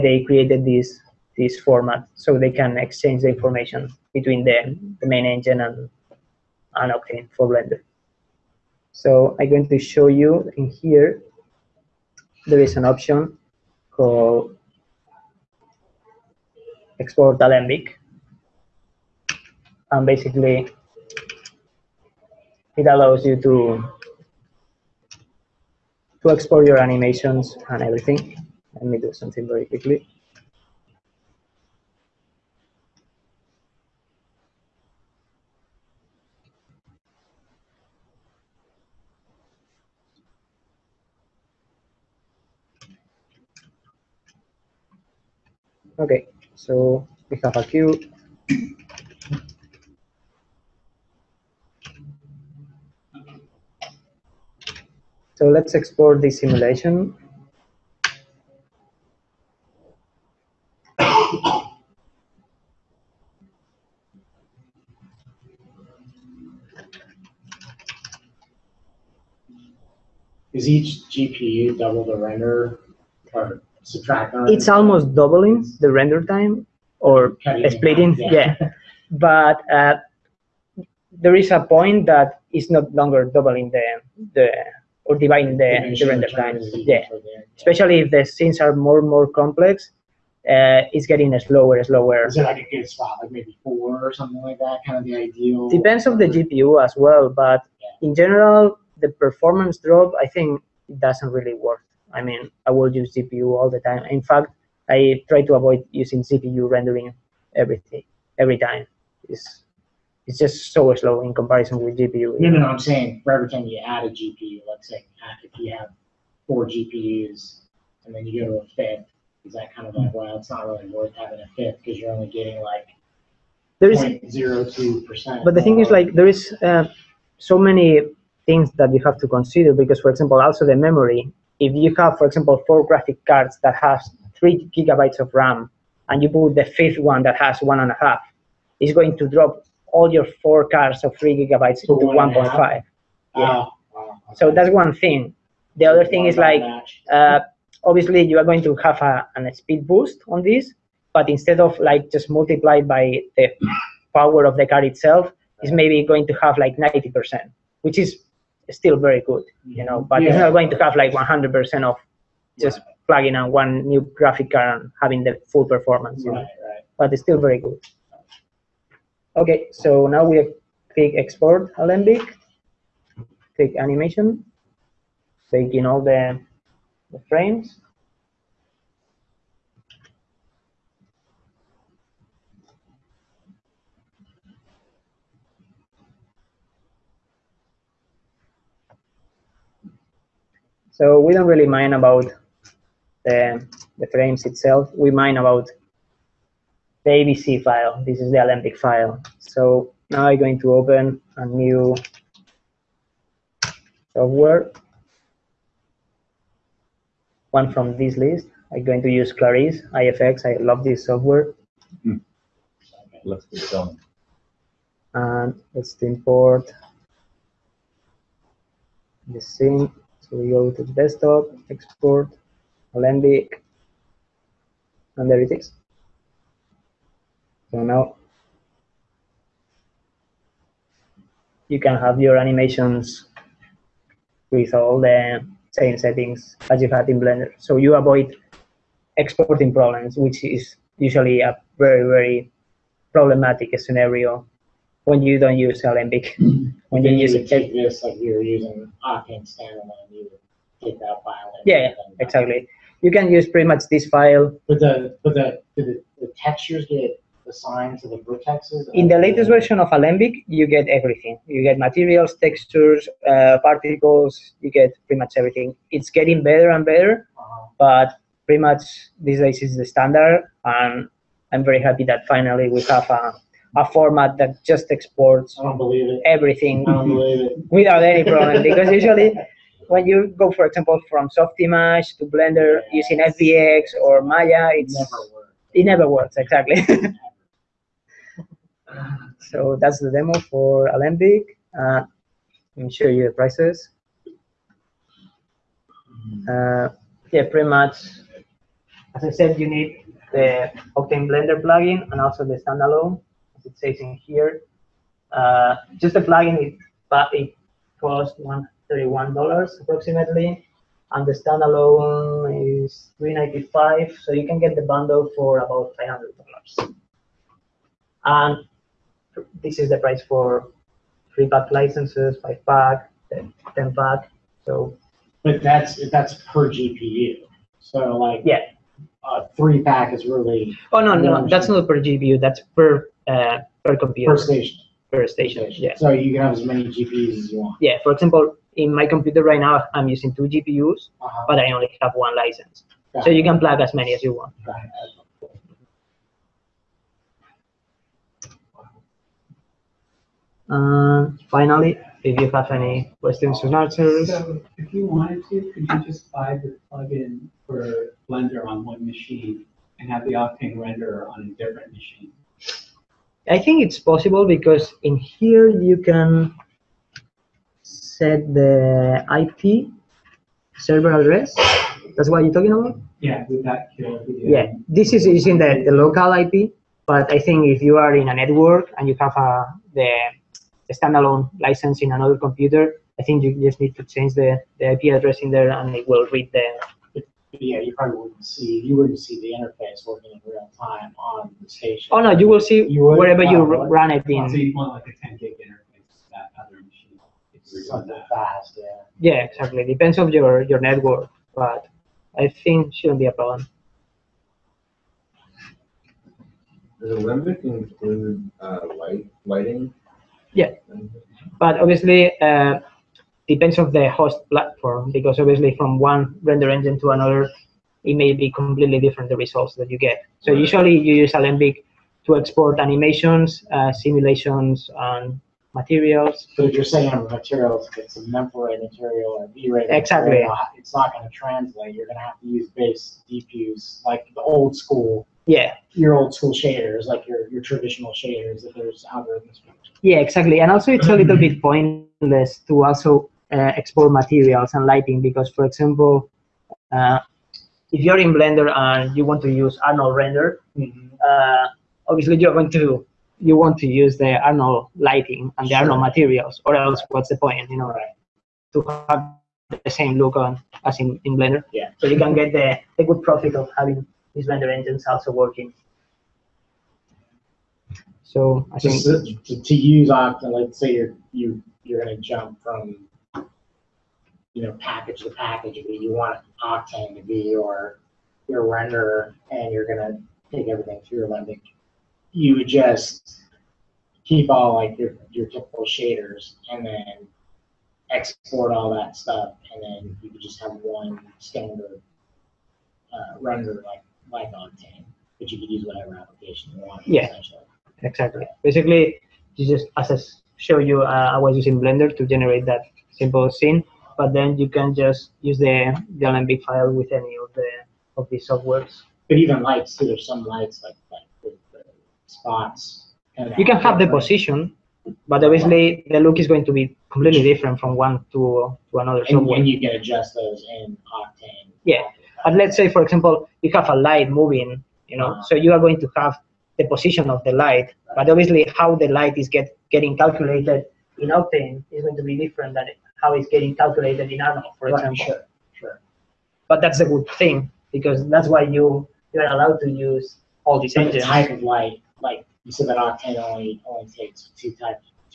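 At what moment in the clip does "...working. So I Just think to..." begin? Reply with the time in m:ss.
7:45.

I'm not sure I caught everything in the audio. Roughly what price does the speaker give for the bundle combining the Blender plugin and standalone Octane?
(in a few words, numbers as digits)
about $500.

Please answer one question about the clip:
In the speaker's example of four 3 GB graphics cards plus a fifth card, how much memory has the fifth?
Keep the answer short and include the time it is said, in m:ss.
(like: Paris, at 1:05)
1.5 GB, at 2:17.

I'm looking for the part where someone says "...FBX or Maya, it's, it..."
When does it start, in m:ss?
4:43.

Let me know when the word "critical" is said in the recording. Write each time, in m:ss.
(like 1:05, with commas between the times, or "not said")
not said.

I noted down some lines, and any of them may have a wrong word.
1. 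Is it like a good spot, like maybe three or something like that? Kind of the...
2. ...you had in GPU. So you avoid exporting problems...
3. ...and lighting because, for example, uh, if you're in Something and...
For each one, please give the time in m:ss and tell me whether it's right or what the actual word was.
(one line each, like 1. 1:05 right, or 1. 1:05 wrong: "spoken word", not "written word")
1. 1:32 wrong: "four", not "three"
2. 3:56 wrong: "Blender", not "GPU"
3. 7:24 wrong: "Blender", not "Something".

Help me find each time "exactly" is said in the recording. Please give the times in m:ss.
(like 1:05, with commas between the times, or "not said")
4:12, 4:46, 6:39, 7:09, 7:20, 8:18.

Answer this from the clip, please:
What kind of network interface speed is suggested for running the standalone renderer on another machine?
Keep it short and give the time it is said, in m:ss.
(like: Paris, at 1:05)
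10 gig, at 6:35.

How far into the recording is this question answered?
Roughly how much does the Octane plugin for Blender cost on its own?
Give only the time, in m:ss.
5:08.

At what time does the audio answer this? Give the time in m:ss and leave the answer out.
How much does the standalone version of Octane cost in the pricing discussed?
5:13.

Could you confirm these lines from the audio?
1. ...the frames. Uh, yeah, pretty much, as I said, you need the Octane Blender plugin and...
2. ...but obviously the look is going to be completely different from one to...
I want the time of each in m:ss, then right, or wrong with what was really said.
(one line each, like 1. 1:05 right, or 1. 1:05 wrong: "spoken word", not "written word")
1. 4:53 wrong: "prices", not "frames"
2. 8:35 right.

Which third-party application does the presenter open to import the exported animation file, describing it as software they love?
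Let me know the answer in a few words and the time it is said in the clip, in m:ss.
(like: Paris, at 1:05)
Clarisse iFX, at 3:29.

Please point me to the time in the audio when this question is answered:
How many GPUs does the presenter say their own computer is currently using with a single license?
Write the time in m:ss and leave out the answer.
5:40.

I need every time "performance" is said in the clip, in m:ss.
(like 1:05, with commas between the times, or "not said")
1:39, 2:45.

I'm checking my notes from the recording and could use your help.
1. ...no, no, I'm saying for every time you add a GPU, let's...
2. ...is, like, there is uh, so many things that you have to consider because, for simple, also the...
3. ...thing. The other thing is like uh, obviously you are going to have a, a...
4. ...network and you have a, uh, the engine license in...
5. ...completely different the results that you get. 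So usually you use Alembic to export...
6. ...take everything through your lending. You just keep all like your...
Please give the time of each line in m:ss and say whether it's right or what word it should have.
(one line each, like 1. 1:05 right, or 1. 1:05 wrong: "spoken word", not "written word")
1. 1:52 right
2. 2:05 wrong: "example", not "simple"
3. 2:24 right
4. 6:18 wrong: "standalone", not "engine"
5. 6:58 right
6. 8:00 right.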